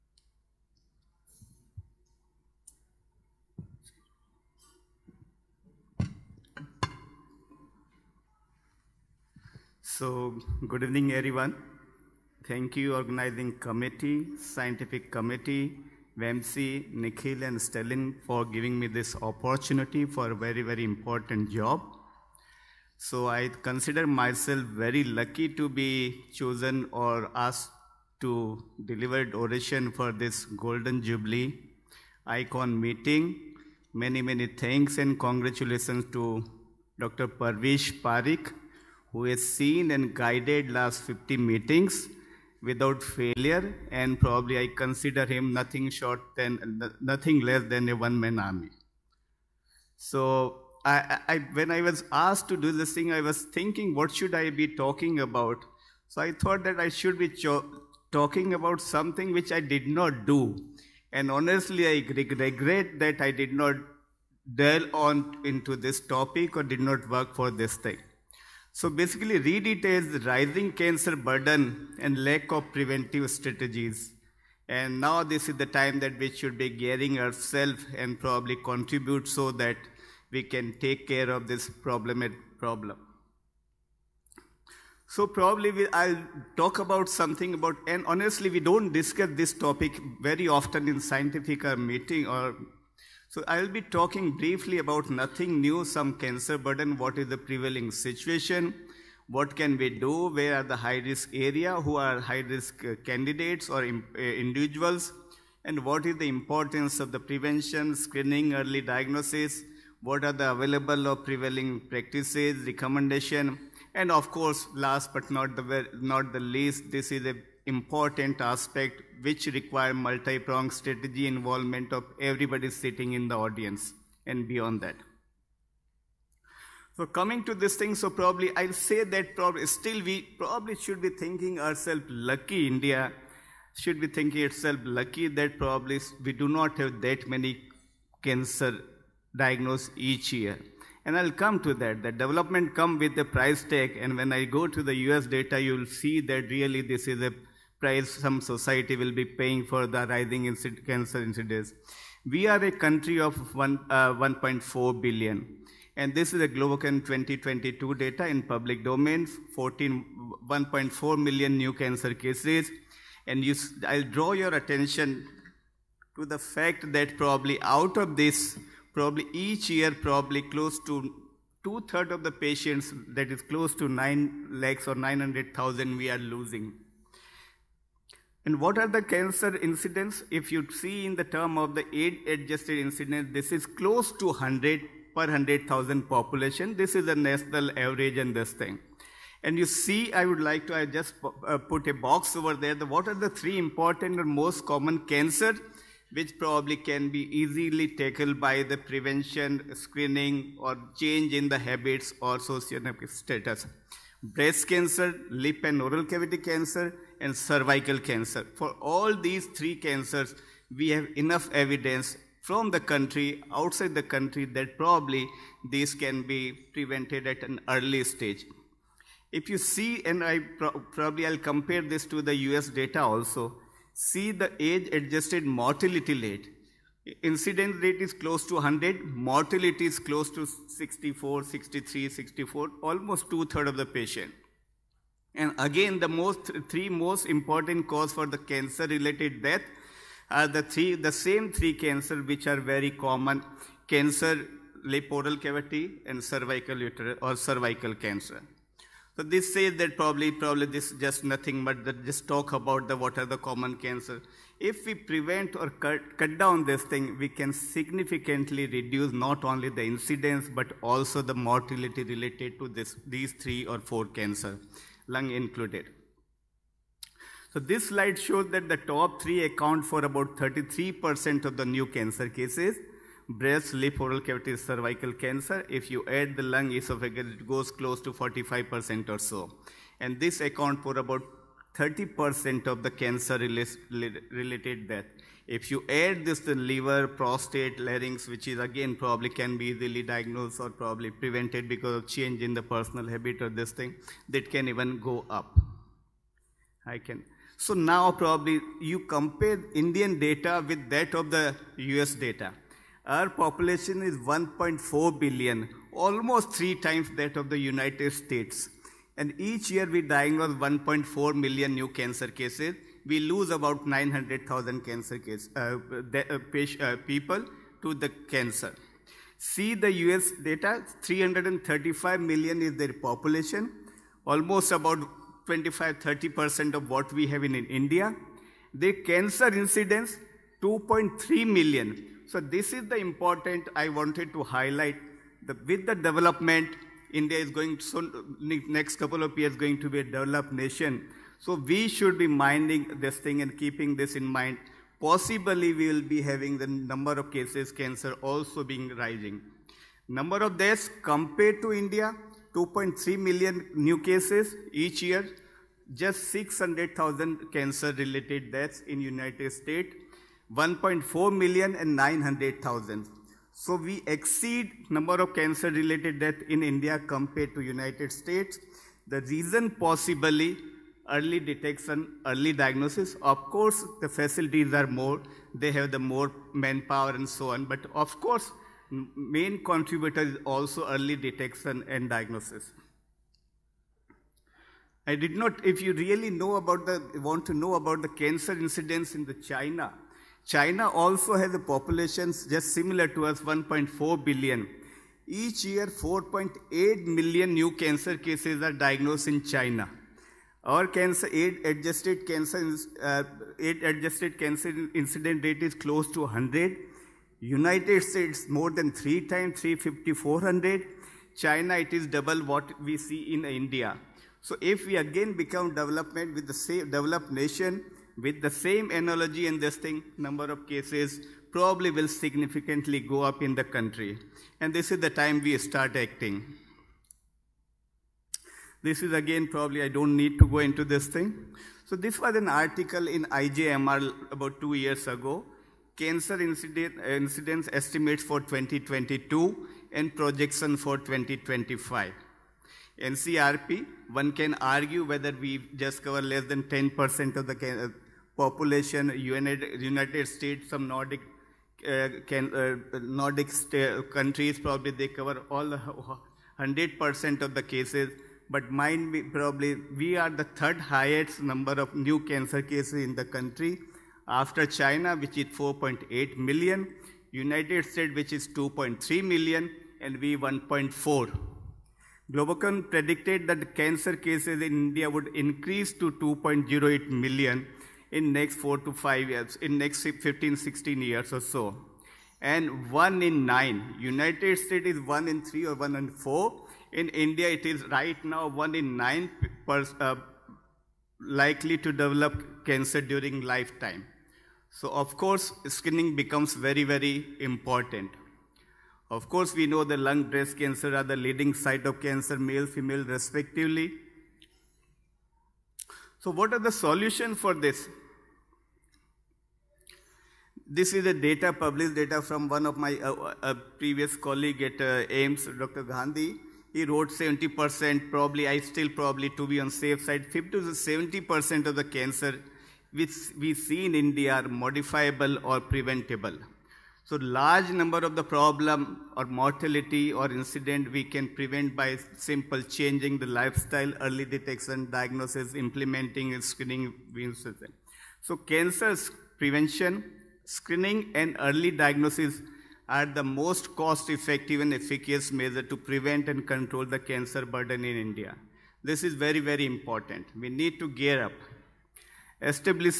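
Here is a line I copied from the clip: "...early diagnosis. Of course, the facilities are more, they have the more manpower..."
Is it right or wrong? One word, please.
right.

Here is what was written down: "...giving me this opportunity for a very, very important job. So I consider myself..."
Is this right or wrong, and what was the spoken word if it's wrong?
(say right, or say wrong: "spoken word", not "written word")
right.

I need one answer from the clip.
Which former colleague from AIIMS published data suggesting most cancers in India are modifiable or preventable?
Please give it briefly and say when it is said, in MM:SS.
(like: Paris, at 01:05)
Dr. Gandhi, at 08:35.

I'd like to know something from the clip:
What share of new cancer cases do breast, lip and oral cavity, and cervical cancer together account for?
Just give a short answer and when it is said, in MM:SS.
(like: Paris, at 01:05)
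33%, at 04:30.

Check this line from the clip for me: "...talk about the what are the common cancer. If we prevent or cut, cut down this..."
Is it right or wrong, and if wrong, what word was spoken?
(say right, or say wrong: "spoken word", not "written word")
right.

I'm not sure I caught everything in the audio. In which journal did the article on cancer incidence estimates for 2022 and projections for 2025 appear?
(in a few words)
IJMR.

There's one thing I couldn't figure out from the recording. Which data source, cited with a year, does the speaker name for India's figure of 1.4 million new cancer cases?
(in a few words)
Globocan 2022.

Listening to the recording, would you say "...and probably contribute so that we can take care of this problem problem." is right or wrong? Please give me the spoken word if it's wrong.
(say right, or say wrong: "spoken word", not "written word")
right.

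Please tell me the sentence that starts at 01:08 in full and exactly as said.
So basically, read it as rising cancer burden and lack of preventive strategies.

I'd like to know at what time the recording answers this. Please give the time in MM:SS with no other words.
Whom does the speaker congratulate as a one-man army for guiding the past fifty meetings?
00:36.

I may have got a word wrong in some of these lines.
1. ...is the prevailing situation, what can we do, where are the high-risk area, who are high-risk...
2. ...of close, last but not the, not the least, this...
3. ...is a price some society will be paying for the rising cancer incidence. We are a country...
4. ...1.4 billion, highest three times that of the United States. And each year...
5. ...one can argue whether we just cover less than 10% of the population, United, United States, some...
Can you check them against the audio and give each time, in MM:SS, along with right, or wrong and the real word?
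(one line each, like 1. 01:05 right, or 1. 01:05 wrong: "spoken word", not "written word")
1. 01:37 right
2. 01:54 wrong: "course", not "close"
3. 02:27 right
4. 05:04 wrong: "almost", not "highest"
5. 07:24 right.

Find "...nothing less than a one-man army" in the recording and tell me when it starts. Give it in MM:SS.
00:46.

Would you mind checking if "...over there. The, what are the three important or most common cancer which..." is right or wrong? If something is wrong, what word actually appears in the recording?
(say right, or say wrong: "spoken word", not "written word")
right.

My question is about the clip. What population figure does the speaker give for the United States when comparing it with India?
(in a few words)
335 million.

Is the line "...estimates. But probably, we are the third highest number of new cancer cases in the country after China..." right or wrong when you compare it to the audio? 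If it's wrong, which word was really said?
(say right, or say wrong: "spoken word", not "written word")
wrong: "cases", not "estimates".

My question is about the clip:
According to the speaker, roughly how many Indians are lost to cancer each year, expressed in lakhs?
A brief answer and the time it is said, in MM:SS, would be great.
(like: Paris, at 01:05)
9 lakhs, at 02:53.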